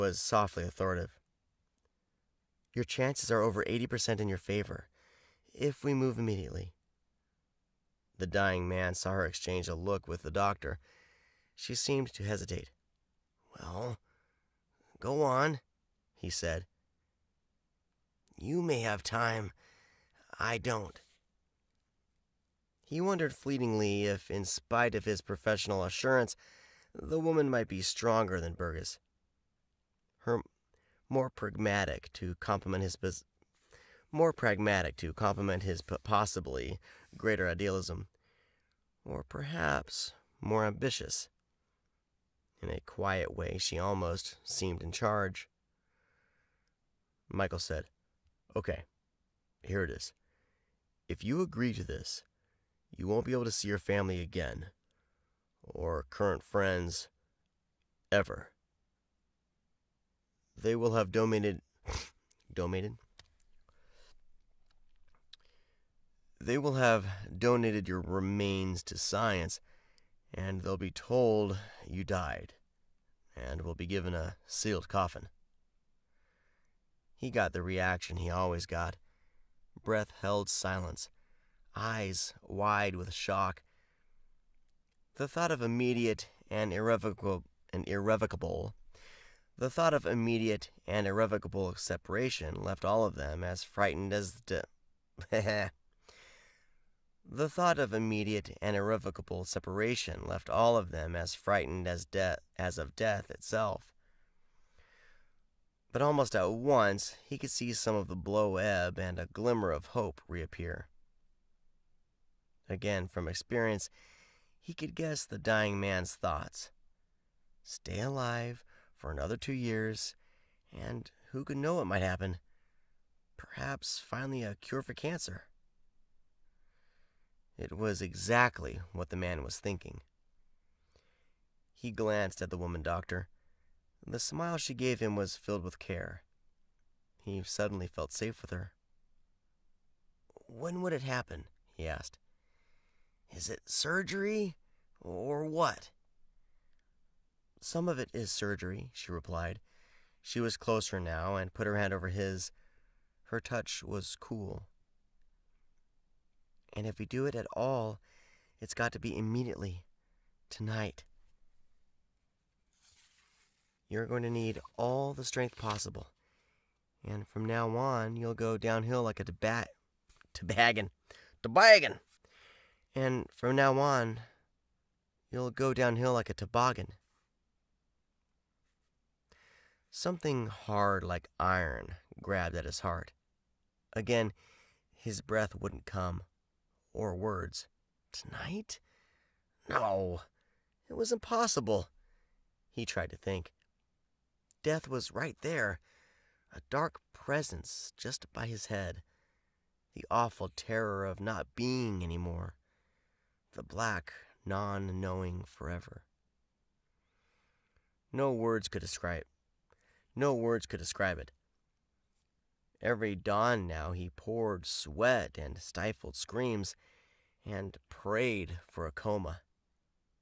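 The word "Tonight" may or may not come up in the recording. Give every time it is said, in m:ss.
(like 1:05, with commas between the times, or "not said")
2:40, 3:08.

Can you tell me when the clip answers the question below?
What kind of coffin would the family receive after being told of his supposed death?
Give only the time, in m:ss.
1:14.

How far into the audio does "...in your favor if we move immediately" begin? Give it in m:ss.
0:04.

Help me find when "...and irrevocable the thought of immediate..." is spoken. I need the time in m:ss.
1:27.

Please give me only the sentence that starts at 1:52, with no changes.
Again, from experience, he could guess the dying man's thoughts.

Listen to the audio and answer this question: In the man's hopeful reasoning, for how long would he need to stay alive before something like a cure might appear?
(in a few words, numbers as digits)
2 years.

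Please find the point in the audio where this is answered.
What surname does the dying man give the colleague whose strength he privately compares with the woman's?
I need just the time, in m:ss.
0:28.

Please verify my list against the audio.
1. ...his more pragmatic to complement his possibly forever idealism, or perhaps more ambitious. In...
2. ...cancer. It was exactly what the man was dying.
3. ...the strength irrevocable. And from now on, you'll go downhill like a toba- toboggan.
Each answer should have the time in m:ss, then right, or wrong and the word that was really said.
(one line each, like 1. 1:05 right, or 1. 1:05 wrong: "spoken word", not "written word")
1. 0:32 wrong: "greater", not "forever"
2. 2:04 wrong: "thinking", not "dying"
3. 2:45 wrong: "possible", not "irrevocable".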